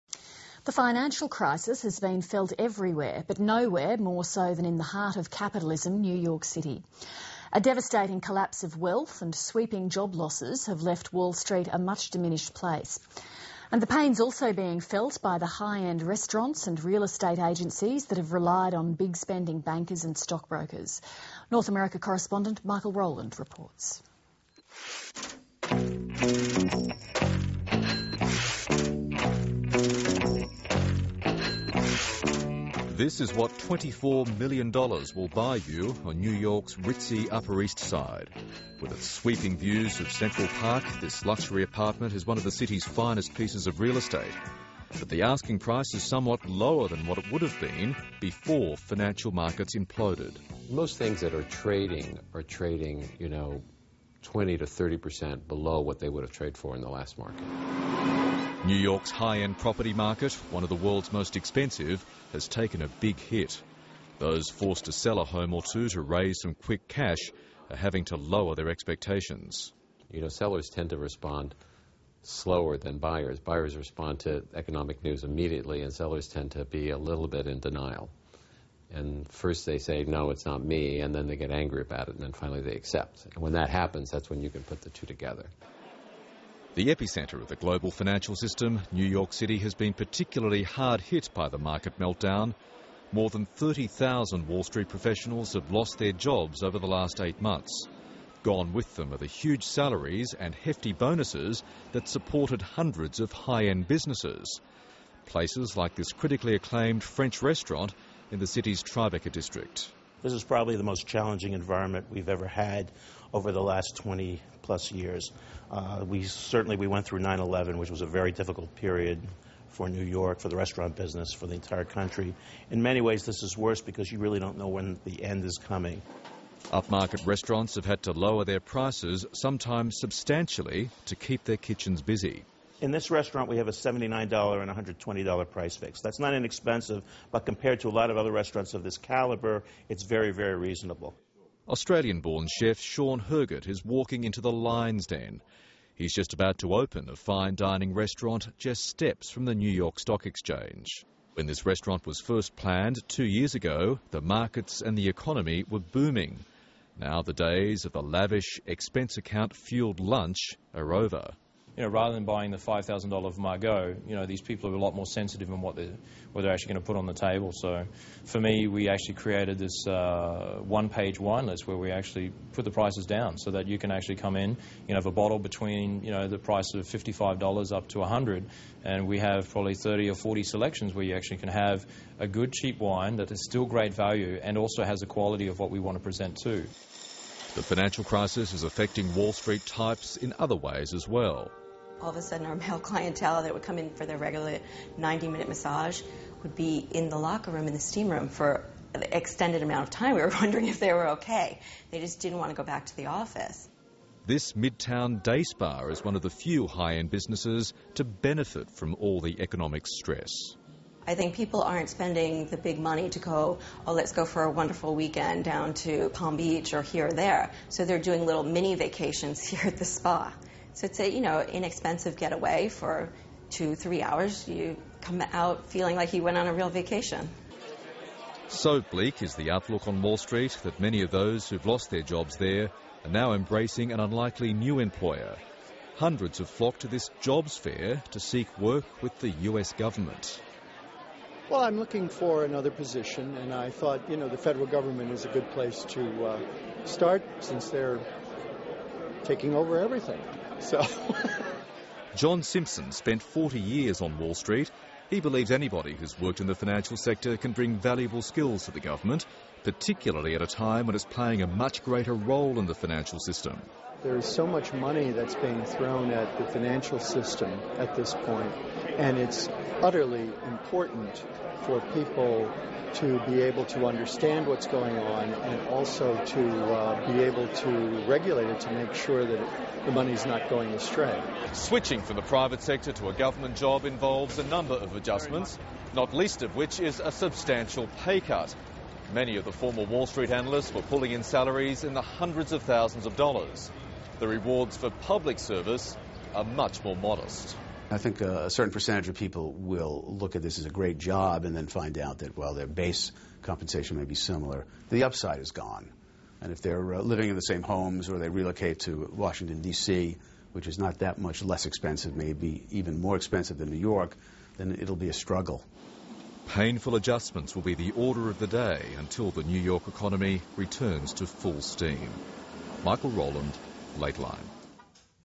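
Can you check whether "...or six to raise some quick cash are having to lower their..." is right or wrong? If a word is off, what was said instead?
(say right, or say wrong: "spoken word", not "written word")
wrong: "two", not "six".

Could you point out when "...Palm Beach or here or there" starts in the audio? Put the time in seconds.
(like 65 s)
216 s.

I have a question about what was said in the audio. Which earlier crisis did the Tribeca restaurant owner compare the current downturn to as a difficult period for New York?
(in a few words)
9/11.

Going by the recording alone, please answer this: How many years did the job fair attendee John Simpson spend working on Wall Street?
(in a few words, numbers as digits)
40 years.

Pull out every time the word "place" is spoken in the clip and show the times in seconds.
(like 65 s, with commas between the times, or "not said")
12 s, 105 s, 245 s.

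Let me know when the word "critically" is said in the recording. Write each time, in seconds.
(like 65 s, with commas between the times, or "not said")
106 s.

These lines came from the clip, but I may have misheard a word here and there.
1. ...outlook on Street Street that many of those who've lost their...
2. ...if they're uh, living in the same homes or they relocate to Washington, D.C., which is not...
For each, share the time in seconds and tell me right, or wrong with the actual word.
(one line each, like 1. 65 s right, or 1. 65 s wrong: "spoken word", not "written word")
1. 229 s wrong: "Wall", not "Street"
2. 306 s right.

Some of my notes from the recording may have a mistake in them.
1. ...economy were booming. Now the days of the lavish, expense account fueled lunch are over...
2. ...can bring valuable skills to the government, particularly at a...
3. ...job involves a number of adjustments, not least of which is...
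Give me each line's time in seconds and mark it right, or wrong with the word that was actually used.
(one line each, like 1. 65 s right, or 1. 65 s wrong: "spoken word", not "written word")
1. 155 s right
2. 257 s right
3. 283 s right.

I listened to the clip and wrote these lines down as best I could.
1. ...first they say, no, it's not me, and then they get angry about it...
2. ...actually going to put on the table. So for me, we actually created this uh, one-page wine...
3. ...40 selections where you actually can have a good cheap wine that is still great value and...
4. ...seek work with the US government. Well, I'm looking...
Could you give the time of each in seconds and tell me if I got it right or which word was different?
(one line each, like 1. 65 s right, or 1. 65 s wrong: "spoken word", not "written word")
1. 79 s right
2. 166 s right
3. 180 s right
4. 238 s right.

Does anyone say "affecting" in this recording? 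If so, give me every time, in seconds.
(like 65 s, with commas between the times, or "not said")
188 s.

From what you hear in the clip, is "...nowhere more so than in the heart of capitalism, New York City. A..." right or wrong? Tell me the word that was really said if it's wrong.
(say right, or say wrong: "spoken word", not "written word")
right.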